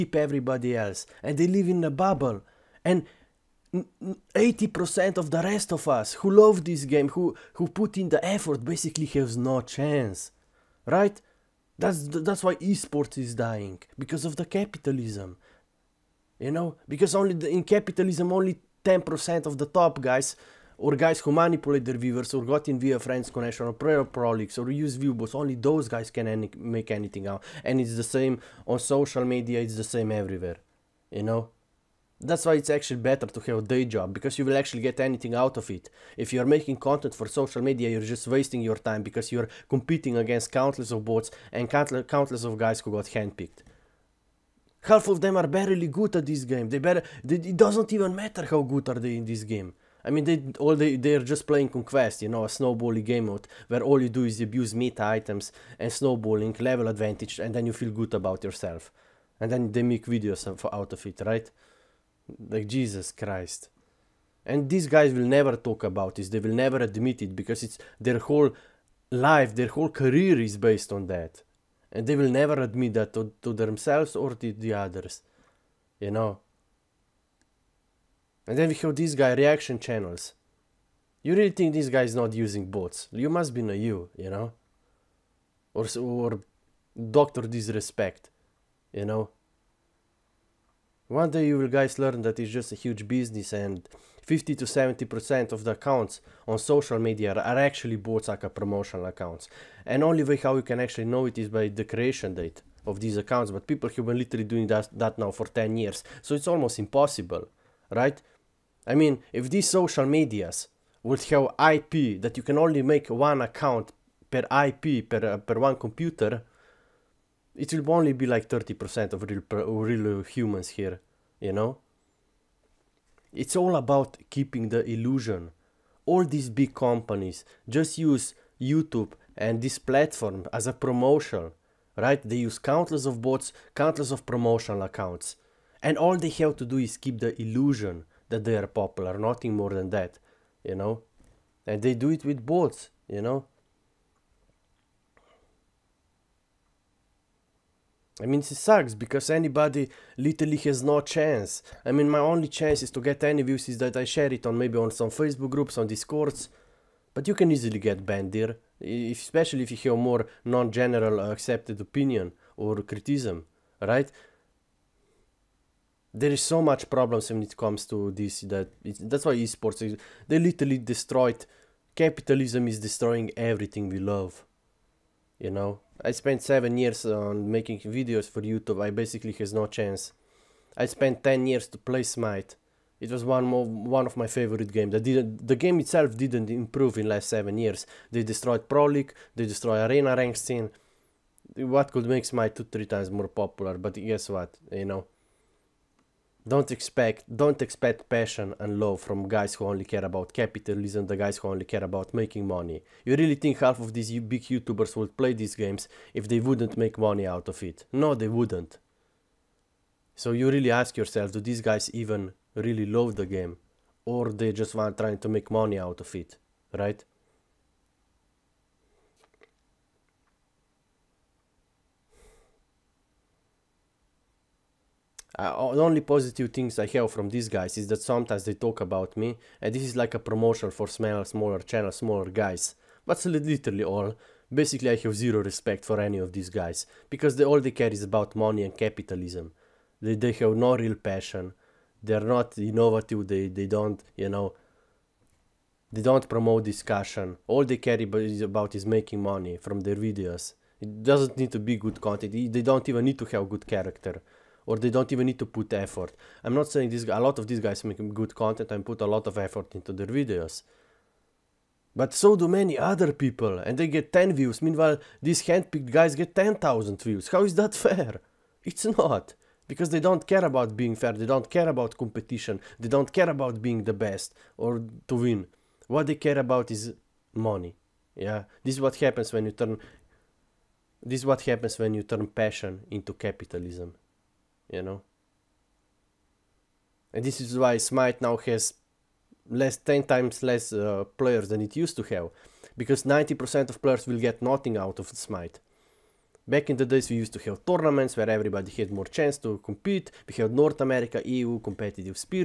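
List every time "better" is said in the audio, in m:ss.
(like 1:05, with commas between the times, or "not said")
0:32, 0:46.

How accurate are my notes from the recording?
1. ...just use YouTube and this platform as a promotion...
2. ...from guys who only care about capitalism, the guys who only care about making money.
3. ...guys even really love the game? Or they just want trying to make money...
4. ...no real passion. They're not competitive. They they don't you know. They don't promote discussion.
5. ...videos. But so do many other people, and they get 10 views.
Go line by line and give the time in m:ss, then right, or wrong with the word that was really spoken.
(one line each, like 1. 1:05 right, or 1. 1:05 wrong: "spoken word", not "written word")
1. 2:07 right
2. 3:19 right
3. 3:31 right
4. 4:00 wrong: "innovative", not "competitive"
5. 4:20 right.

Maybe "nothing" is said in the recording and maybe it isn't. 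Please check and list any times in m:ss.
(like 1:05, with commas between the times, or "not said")
2:19, 4:54.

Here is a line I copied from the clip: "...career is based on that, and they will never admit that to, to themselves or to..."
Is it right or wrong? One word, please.
right.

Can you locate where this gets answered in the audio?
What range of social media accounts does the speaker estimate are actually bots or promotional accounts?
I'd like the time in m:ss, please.
1:34.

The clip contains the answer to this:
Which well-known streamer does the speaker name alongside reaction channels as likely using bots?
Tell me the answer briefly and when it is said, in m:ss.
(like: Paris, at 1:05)
Doctor Disrespect, at 1:27.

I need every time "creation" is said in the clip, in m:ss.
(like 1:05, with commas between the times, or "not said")
1:41.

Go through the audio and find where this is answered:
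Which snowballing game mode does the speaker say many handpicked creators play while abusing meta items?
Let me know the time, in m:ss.
0:51.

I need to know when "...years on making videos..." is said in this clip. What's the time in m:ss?
2:56.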